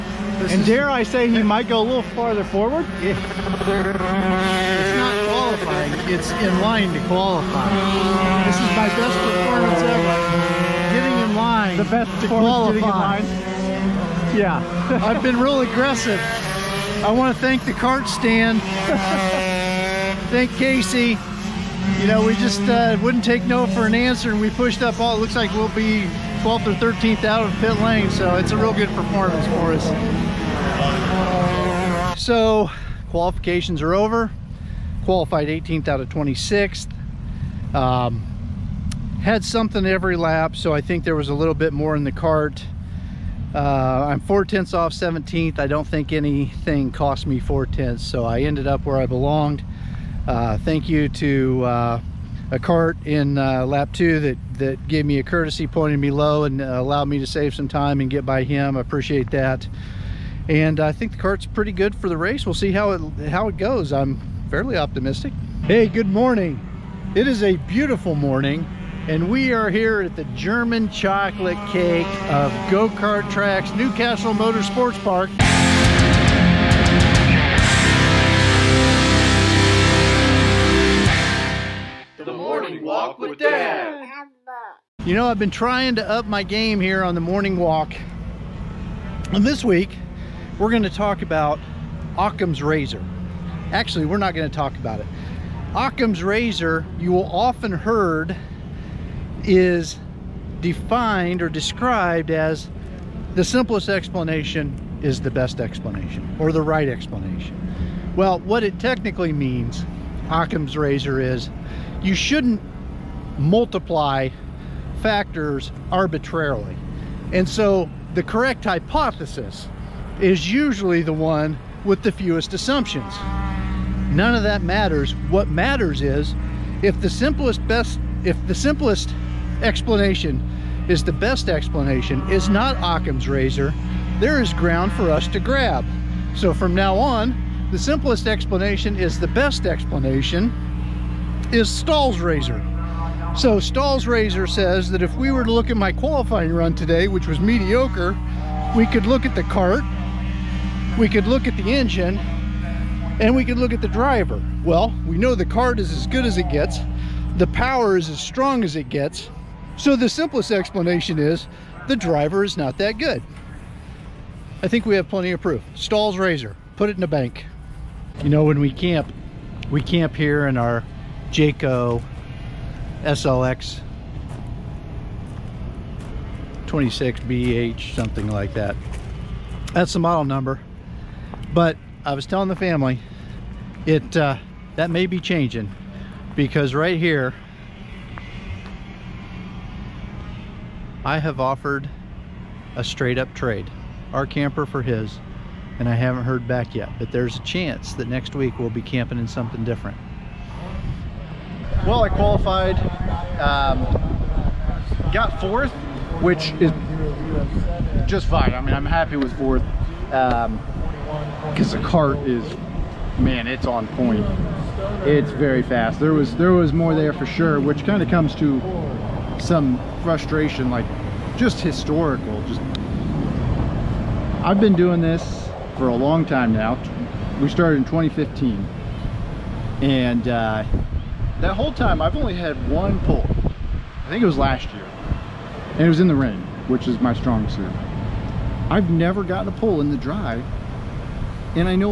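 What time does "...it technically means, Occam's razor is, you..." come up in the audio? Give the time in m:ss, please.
1:48.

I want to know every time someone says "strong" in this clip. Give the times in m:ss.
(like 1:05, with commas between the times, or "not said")
2:38, 3:57.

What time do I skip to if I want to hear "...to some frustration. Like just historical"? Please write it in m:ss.
3:38.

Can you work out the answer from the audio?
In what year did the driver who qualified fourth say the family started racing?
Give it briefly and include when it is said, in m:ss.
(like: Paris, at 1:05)
2015, at 3:47.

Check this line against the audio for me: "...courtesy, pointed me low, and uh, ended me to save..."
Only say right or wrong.
wrong.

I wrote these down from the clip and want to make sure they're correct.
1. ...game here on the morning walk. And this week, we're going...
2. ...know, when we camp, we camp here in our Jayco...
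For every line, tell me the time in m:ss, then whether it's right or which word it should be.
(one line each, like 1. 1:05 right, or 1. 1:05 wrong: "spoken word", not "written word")
1. 1:26 right
2. 2:48 right.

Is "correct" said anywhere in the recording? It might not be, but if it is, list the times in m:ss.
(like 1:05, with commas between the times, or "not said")
1:58.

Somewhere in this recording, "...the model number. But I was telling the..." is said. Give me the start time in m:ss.
2:59.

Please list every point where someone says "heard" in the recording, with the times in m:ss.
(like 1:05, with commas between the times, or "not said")
1:37, 3:16.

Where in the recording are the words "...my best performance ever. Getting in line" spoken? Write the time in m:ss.
0:08.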